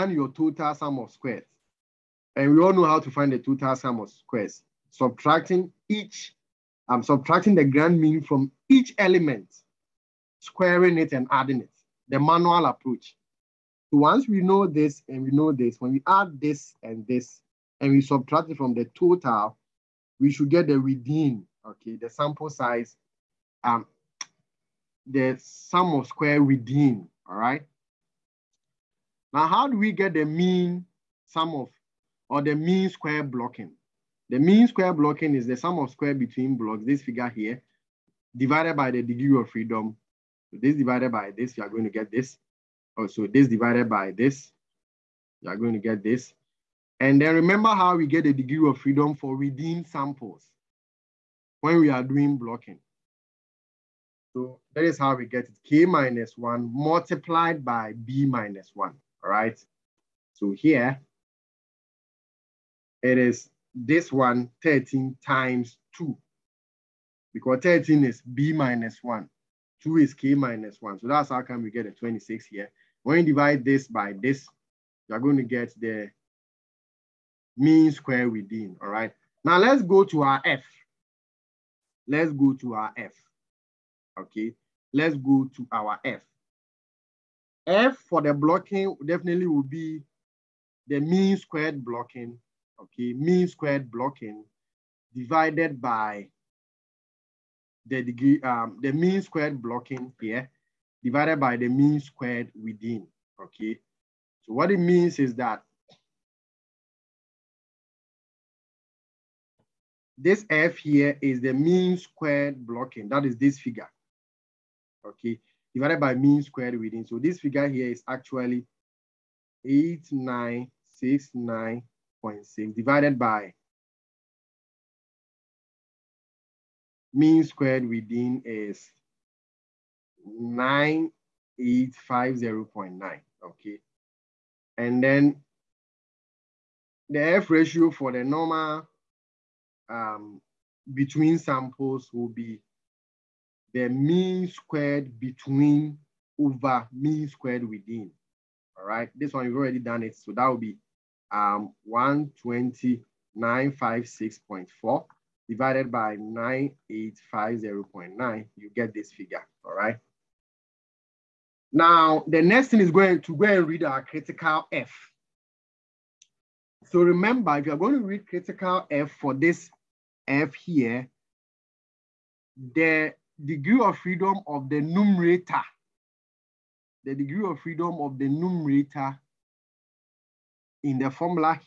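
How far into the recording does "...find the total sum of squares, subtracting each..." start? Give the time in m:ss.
0:03.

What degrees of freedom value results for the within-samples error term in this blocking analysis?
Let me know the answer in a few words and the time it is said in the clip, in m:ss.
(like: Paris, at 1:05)
26, at 1:11.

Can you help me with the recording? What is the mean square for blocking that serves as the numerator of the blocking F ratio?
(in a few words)
8969.6.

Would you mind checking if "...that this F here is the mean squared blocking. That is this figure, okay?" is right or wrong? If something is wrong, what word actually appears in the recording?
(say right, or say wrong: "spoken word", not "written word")
right.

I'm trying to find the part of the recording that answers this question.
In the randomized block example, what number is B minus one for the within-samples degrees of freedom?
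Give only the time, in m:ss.
1:07.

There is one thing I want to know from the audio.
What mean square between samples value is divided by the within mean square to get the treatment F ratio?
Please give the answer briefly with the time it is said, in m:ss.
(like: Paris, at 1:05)
12956.4, at 2:31.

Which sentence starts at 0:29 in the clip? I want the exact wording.
Now, how do we get the mean sum of, or the mean square blocking?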